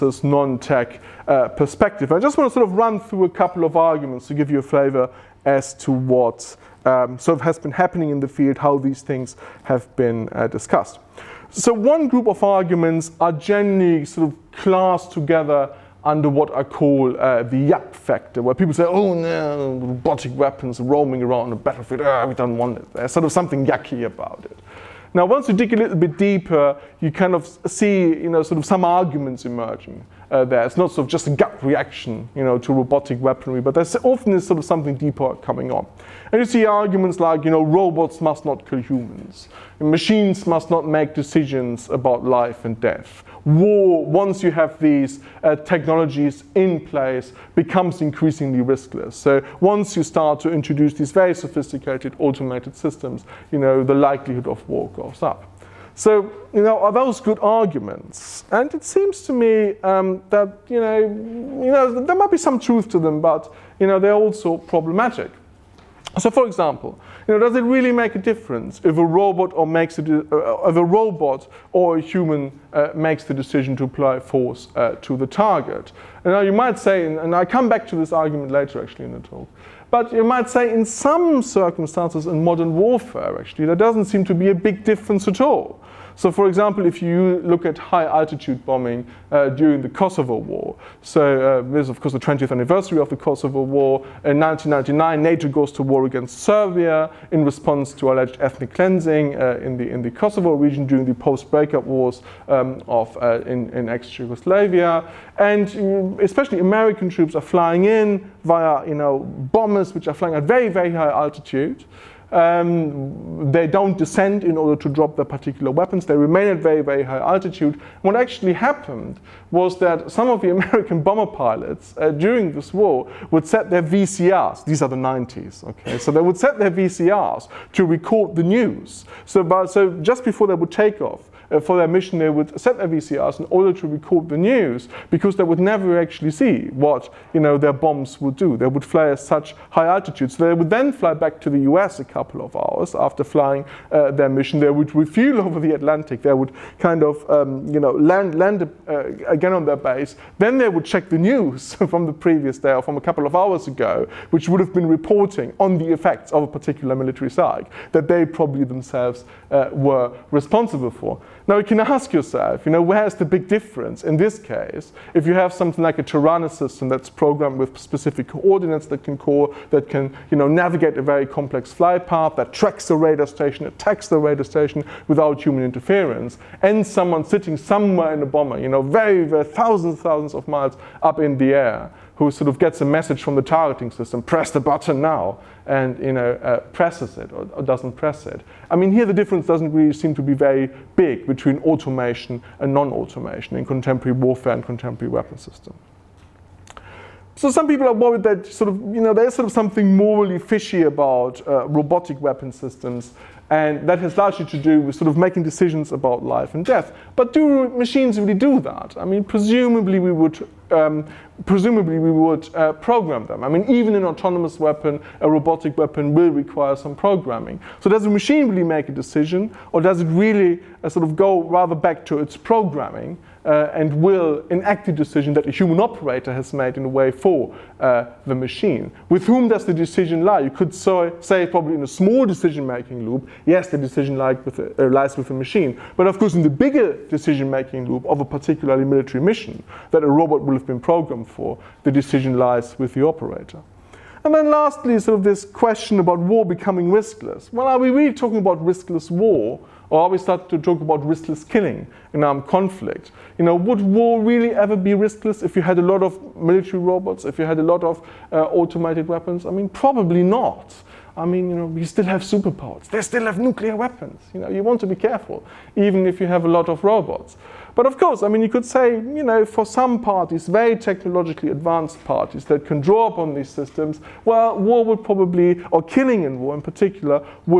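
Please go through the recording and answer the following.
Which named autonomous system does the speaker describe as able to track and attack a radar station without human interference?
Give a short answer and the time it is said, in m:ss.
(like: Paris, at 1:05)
Taranis, at 2:46.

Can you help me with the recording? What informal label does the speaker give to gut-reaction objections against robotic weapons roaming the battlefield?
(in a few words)
the yap factor.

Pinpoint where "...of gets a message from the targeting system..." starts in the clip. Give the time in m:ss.
3:02.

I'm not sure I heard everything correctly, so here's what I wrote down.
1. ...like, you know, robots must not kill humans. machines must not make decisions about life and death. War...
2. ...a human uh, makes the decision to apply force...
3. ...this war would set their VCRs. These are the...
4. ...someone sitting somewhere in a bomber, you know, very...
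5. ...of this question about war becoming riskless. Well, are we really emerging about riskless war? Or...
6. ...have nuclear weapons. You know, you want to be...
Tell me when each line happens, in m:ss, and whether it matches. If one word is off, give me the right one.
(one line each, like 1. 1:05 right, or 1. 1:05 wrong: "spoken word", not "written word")
1. 0:37 right
2. 1:11 right
3. 2:02 right
4. 2:56 right
5. 4:05 wrong: "talking", not "emerging"
6. 4:23 right.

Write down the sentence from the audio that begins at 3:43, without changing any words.
uh, and will enact the decision that a human operator has made in a way for uh, the machine.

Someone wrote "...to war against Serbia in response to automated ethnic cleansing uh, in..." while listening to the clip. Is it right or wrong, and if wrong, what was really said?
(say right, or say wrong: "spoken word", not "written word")
wrong: "alleged", not "automated".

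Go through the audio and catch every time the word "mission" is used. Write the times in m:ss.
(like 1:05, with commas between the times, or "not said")
2:11, 2:24, 3:59.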